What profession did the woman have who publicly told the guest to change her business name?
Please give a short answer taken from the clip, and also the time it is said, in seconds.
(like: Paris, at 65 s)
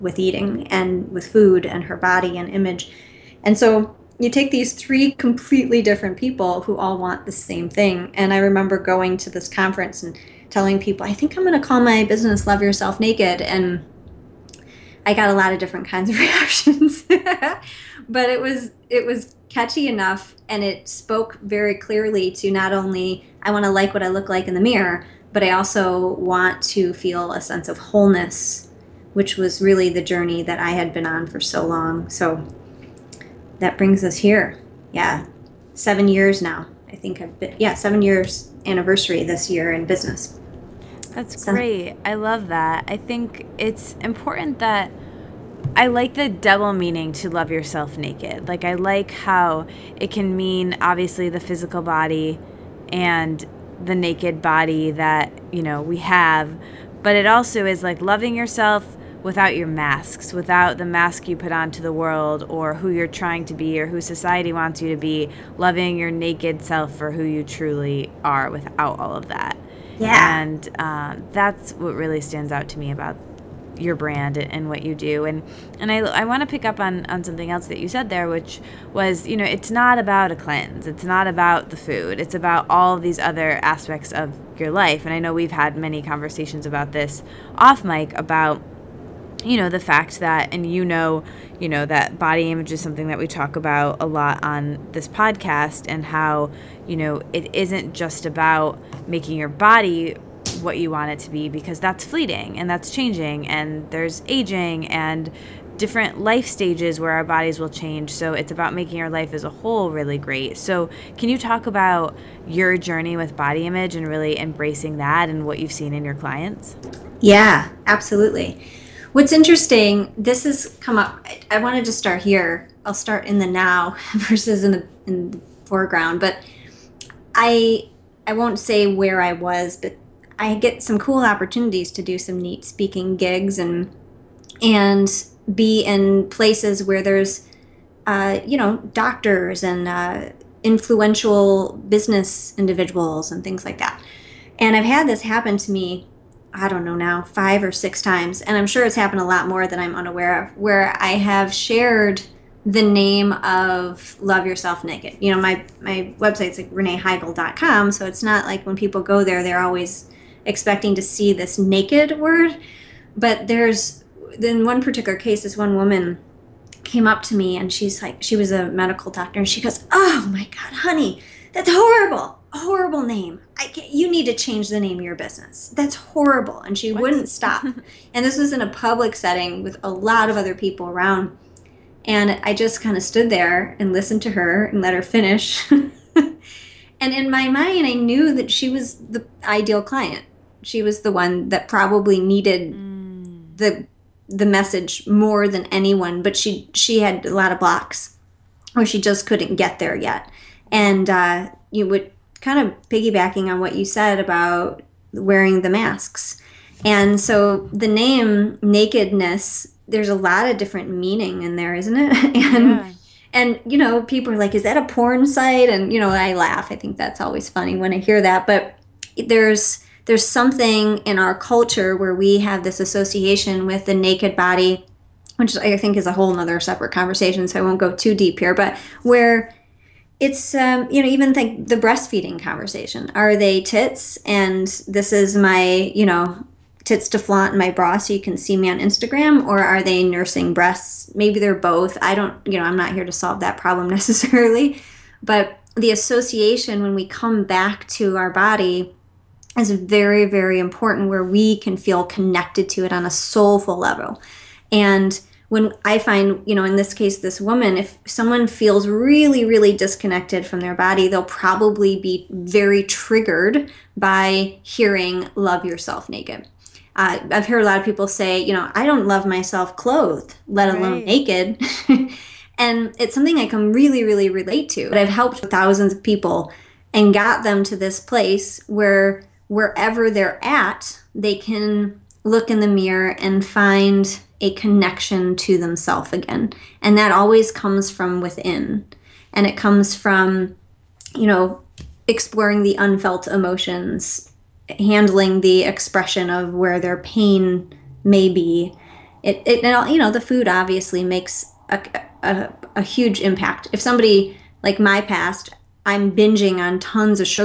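Medical doctor, at 168 s.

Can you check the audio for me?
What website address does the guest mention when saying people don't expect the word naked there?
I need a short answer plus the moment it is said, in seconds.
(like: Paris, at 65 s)
reneeheigel.com, at 156 s.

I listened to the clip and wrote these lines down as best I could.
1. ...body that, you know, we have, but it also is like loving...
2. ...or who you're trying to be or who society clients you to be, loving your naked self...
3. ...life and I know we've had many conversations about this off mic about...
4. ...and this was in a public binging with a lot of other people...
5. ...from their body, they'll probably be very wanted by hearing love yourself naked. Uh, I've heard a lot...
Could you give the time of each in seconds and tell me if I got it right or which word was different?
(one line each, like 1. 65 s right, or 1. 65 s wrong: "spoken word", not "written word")
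1. 54 s right
2. 62 s wrong: "wants", not "clients"
3. 84 s right
4. 178 s wrong: "setting", not "binging"
5. 260 s wrong: "triggered", not "wanted".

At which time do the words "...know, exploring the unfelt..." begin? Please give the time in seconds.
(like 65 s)
291 s.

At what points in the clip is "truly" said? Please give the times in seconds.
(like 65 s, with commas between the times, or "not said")
67 s.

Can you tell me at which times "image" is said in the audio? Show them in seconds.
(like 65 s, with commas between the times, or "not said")
2 s, 92 s, 113 s.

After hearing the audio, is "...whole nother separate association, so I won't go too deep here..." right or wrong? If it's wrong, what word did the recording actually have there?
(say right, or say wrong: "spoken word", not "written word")
wrong: "conversation", not "association".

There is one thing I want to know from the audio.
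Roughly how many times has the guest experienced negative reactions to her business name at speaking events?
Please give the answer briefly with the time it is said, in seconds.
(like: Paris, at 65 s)
5 or 6, at 147 s.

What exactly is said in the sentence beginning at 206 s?
And so the name nakedness, there's a lot of different meaning in there, isn't it?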